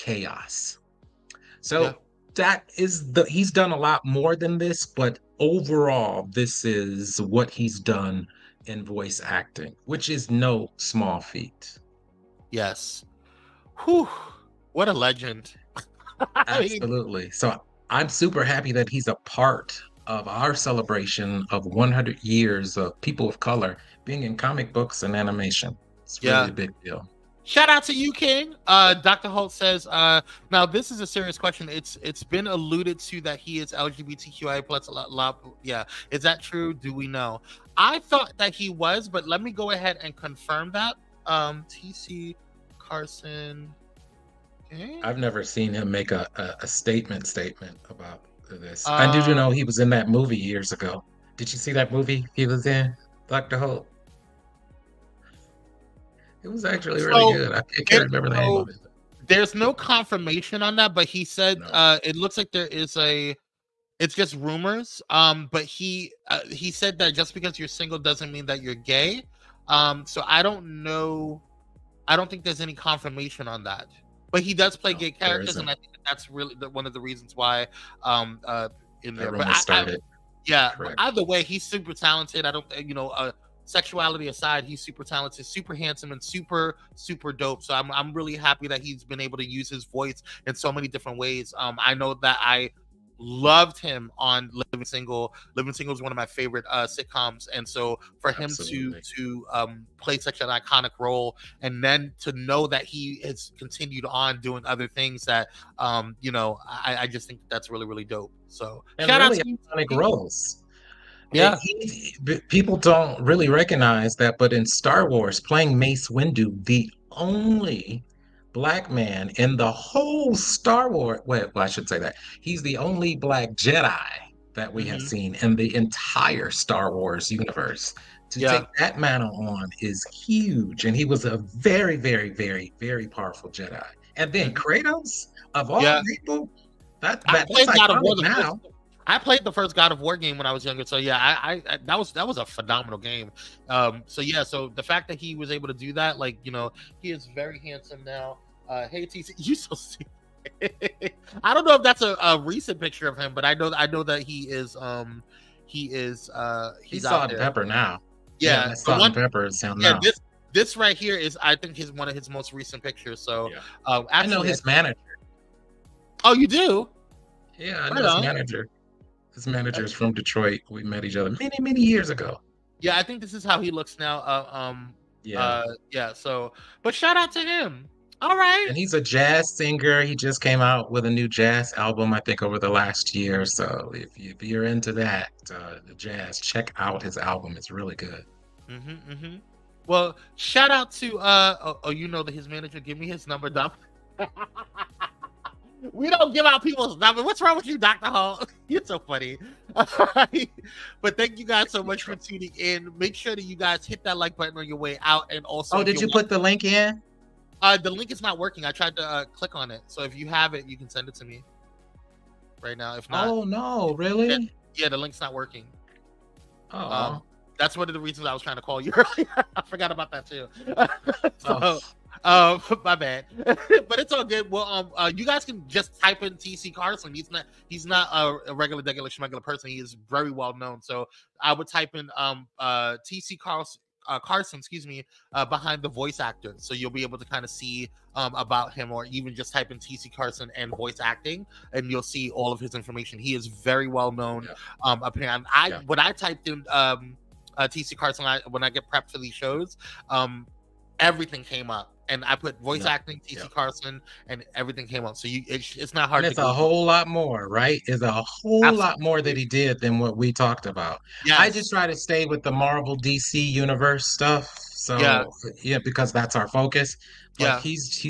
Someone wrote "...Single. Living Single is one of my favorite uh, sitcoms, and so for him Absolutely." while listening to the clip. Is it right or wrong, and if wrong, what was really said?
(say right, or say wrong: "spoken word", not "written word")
right.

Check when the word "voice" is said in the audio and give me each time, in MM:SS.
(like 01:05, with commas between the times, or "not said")
00:08, 01:29, 03:55, 04:00, 04:12.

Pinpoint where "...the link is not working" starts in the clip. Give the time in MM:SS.
03:27.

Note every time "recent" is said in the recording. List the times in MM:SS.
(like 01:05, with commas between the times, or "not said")
02:32, 02:42.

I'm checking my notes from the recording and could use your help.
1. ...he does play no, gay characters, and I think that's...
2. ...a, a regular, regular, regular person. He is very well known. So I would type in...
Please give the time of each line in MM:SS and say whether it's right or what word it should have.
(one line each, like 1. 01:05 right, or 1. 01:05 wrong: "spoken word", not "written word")
1. 01:14 right
2. 03:48 right.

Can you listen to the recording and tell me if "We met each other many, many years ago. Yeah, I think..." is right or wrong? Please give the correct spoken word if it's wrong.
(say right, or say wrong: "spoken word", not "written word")
right.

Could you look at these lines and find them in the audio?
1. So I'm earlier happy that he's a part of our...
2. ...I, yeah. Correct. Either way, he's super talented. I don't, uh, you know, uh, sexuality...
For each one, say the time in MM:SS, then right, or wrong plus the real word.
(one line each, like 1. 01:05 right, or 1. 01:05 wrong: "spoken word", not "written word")
1. 00:17 wrong: "super", not "earlier"
2. 01:19 right.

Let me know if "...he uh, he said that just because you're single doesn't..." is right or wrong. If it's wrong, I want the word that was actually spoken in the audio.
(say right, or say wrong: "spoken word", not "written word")
right.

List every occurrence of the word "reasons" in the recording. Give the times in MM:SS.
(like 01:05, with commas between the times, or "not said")
01:17, 03:37.